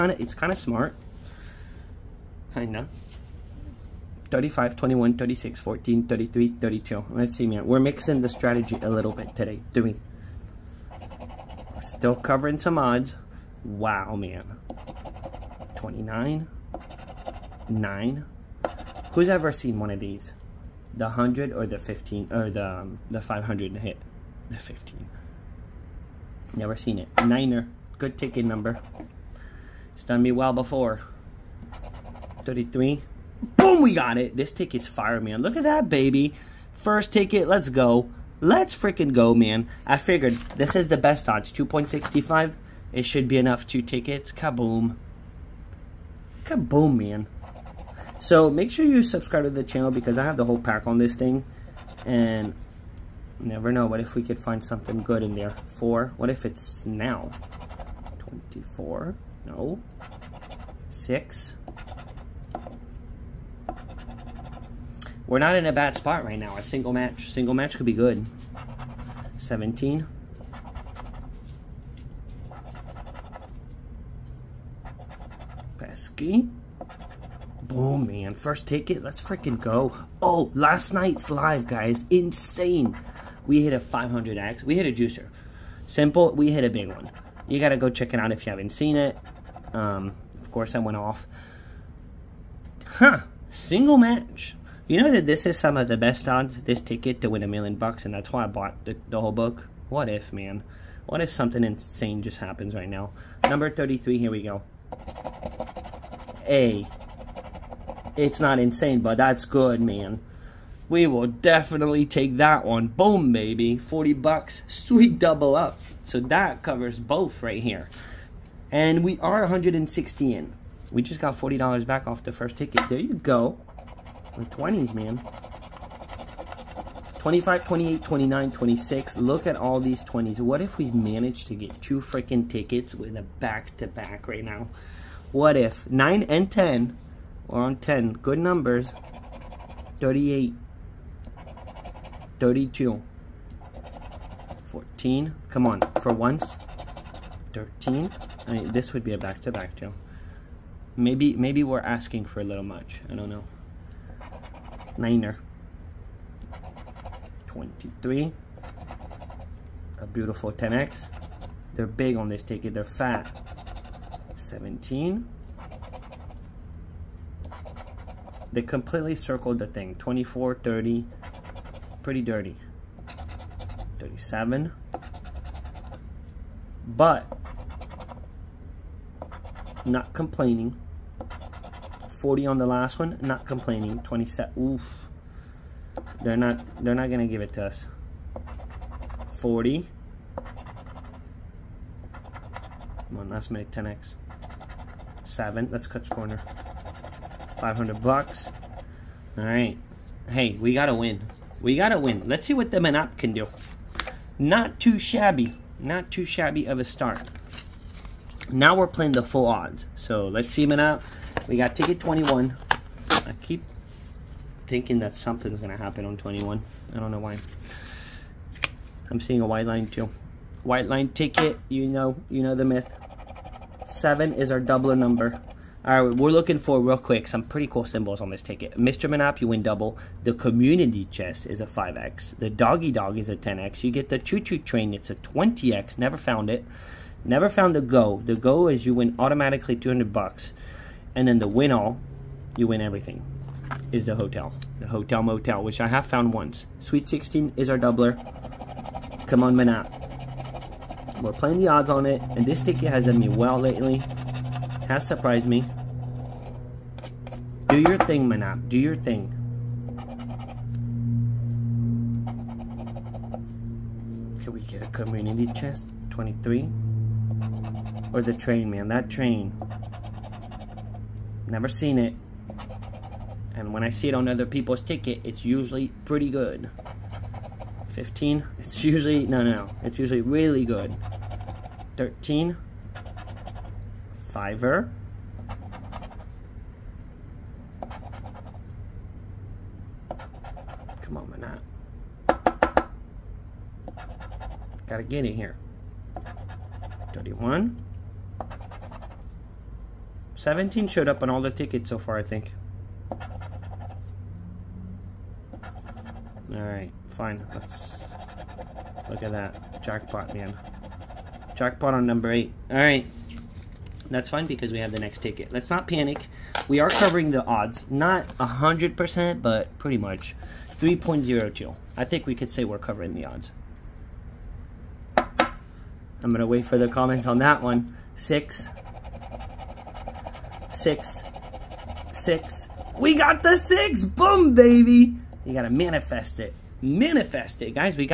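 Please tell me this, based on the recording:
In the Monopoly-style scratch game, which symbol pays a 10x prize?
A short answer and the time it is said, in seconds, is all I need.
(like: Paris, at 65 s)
The doggy dog, at 232 s.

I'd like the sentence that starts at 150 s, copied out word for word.
Maybe, maybe we're asking for a little much, I don't know.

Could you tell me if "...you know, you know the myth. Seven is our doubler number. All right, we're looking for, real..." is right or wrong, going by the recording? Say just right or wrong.
right.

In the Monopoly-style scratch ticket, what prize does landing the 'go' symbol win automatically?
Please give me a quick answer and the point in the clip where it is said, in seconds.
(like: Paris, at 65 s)
200 bucks, at 239 s.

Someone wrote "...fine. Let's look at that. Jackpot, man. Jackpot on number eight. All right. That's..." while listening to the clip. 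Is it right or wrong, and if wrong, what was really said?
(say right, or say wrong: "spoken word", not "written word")
right.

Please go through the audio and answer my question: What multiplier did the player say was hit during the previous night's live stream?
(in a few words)
500X.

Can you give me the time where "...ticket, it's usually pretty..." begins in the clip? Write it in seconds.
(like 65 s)
274 s.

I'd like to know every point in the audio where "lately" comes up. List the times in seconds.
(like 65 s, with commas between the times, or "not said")
253 s.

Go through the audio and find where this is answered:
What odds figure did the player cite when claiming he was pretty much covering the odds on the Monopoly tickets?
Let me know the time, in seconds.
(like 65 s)
320 s.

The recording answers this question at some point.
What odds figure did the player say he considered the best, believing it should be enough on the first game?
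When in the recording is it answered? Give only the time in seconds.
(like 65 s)
41 s.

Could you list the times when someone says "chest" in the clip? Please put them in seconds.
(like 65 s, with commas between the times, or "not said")
231 s, 265 s.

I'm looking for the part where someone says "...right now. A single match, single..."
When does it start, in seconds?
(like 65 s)
66 s.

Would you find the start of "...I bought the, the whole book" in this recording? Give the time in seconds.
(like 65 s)
98 s.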